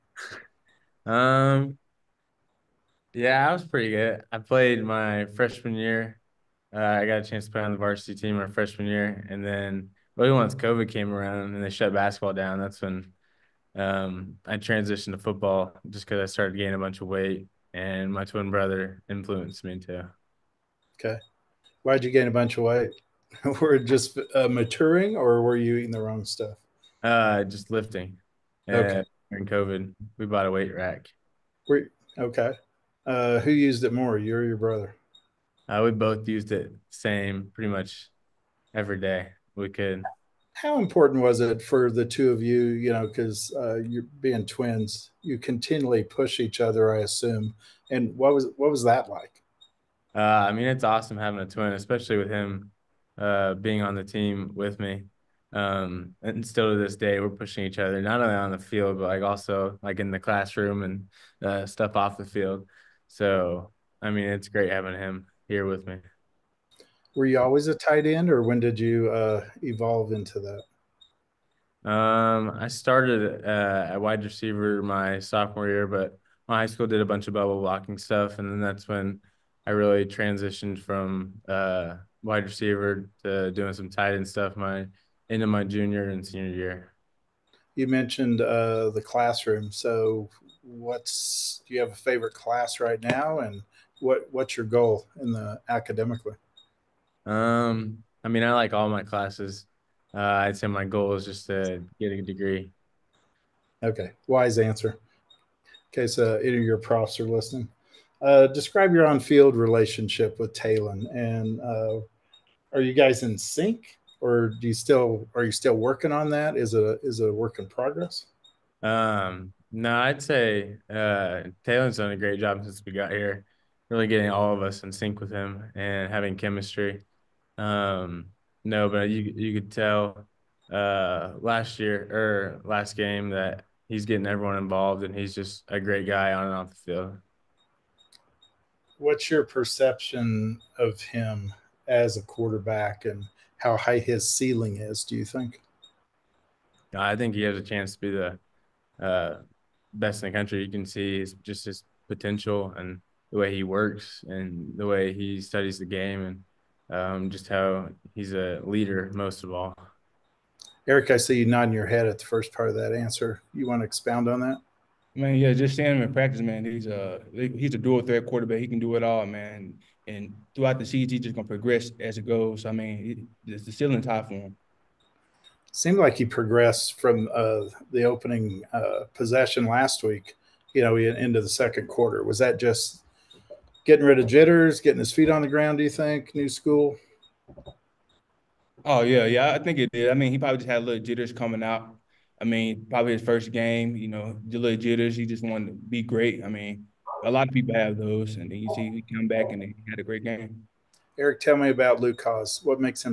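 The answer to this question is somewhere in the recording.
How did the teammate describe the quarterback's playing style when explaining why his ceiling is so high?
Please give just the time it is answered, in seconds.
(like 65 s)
167 s.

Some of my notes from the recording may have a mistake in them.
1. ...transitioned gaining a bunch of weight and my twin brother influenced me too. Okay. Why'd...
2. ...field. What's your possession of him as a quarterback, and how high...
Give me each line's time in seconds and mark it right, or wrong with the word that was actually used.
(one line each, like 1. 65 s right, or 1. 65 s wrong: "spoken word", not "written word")
1. 16 s wrong: "started", not "transitioned"
2. 136 s wrong: "perception", not "possession".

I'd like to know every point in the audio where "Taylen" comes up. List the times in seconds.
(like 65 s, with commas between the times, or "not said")
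110 s, 121 s.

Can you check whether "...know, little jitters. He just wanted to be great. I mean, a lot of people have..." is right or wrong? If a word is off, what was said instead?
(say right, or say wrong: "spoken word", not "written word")
right.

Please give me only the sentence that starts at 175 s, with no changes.
Seemed like he progressed from uh, the opening uh, possession last week.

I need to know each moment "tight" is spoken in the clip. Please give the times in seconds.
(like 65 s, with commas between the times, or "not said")
67 s, 83 s.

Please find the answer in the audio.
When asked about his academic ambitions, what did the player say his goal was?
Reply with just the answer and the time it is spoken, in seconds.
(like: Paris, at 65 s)
to get a degree, at 101 s.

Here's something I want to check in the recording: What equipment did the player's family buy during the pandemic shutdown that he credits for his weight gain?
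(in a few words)
weight rack.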